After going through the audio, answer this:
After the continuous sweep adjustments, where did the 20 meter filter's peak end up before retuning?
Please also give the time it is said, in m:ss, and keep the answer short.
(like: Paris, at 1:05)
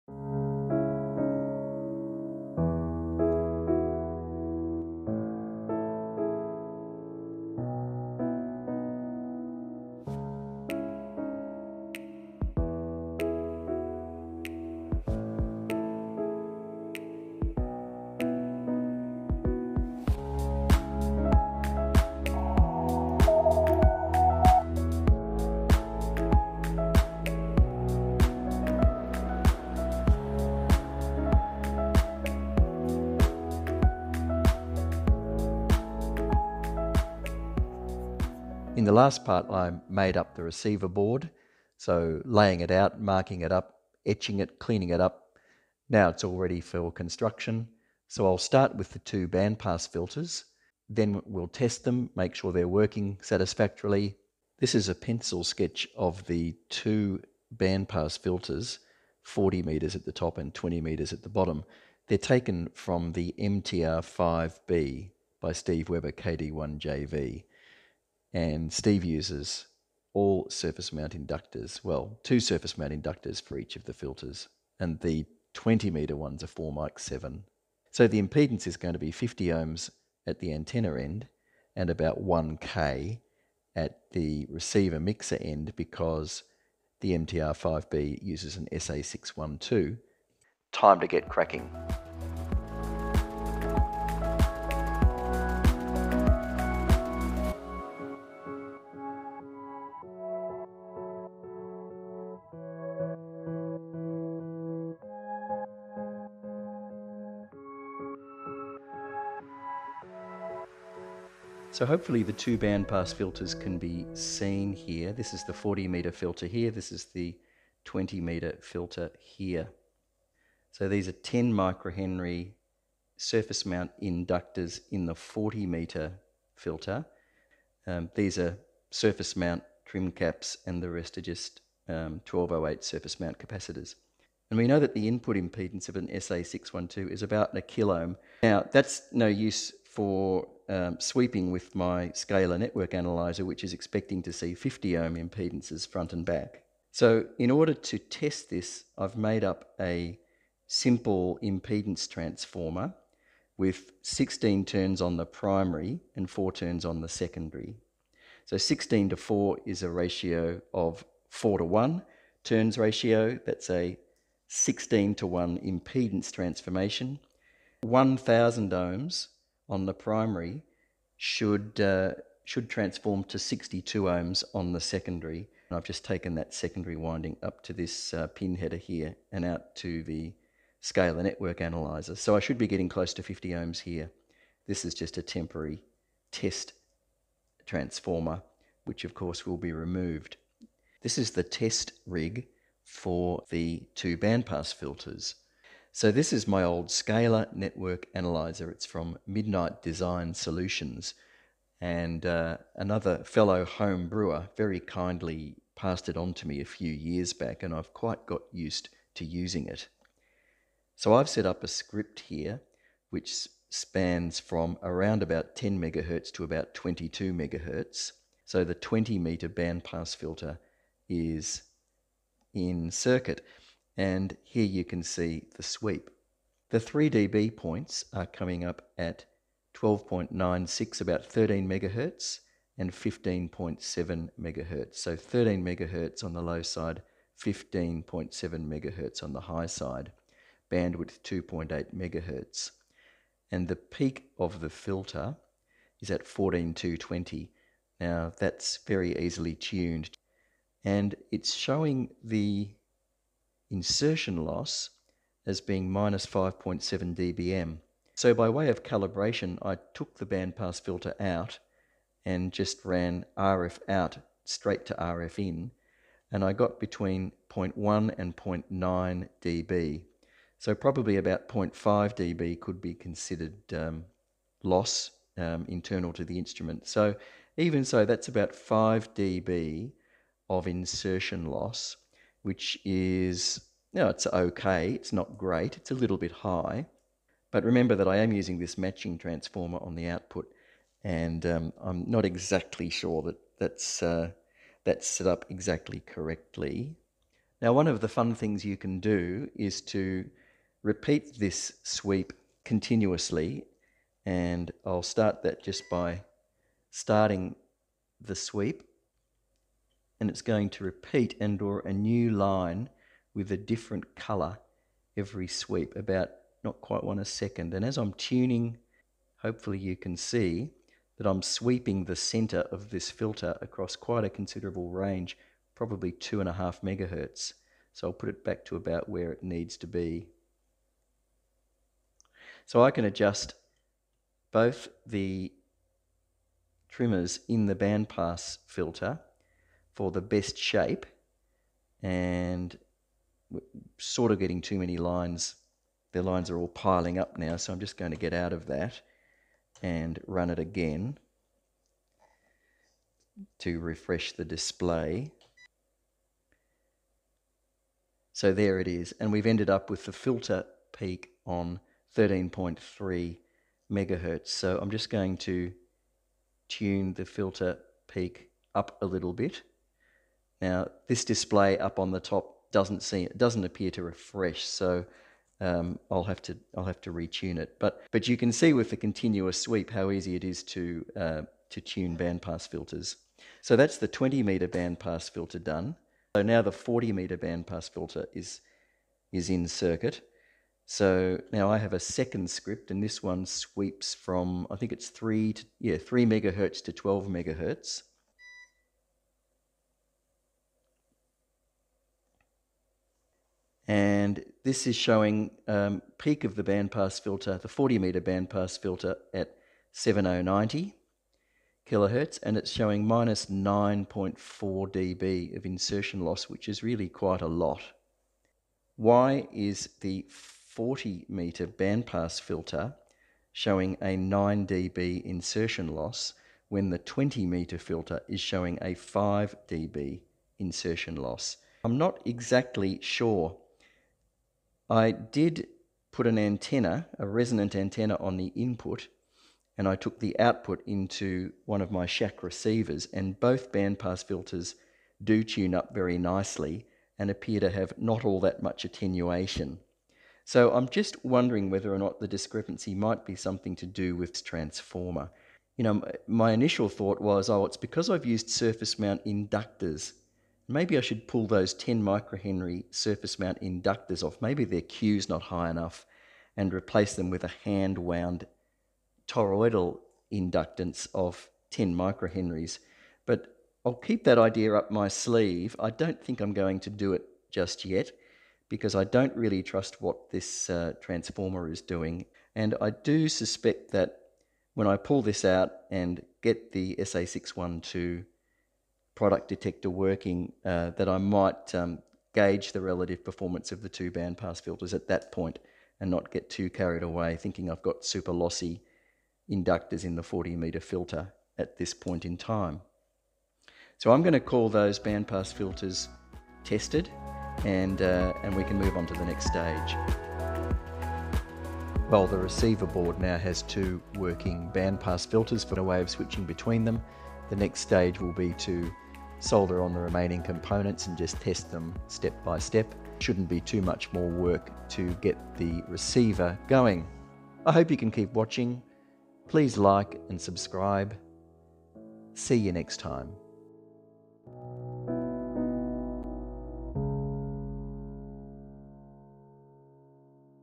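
13.3 MHz, at 6:02.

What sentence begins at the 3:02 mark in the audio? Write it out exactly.
So I should be getting close to 50 ohms here.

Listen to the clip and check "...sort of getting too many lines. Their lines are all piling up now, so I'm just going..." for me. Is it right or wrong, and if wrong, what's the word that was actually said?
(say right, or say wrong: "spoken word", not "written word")
right.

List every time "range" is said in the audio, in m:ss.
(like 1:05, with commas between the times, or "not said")
5:24.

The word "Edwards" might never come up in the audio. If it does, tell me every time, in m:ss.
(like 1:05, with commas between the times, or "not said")
not said.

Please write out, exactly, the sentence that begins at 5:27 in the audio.
So I'll put it back to about where it needs to be.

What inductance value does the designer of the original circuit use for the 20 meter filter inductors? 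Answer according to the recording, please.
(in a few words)
4.7 microhenries.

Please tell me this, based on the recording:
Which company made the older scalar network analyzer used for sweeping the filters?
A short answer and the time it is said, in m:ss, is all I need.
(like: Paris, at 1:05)
Midnight Design Solutions, at 3:19.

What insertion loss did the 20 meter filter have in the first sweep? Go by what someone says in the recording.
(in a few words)
-5.7 dB.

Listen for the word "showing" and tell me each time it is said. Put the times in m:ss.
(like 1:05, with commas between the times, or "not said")
4:11, 6:44, 6:52, 7:03, 7:08.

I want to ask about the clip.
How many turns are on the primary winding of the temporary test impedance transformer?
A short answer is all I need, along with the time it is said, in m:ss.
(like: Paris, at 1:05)
16, at 2:34.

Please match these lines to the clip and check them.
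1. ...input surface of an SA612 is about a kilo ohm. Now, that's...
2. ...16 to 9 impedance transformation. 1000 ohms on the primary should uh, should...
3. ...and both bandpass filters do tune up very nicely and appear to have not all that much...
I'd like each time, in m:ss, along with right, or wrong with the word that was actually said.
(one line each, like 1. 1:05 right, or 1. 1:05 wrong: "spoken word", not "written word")
1. 2:15 wrong: "impedance", not "surface"
2. 2:44 wrong: "1", not "9"
3. 7:23 right.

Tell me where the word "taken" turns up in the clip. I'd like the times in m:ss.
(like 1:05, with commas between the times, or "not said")
1:02, 2:56.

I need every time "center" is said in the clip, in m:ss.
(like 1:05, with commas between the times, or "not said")
5:22.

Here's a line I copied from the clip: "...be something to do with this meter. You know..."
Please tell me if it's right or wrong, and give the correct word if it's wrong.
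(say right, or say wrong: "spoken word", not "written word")
wrong: "transformer", not "meter".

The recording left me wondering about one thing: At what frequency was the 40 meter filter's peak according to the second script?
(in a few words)
7090 kHz.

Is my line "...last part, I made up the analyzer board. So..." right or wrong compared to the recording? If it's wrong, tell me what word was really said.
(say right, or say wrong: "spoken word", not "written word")
wrong: "receiver", not "analyzer".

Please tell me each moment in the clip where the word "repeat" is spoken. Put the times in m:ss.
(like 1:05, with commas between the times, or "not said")
5:00, 5:10.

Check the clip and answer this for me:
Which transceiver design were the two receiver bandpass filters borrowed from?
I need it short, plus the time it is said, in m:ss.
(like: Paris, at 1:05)
MTR5B, at 1:03.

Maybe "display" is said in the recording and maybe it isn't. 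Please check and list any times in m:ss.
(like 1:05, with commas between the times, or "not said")
5:54, 6:11.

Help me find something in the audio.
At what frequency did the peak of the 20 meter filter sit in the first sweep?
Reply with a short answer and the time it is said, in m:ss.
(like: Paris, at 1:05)
14220, at 4:06.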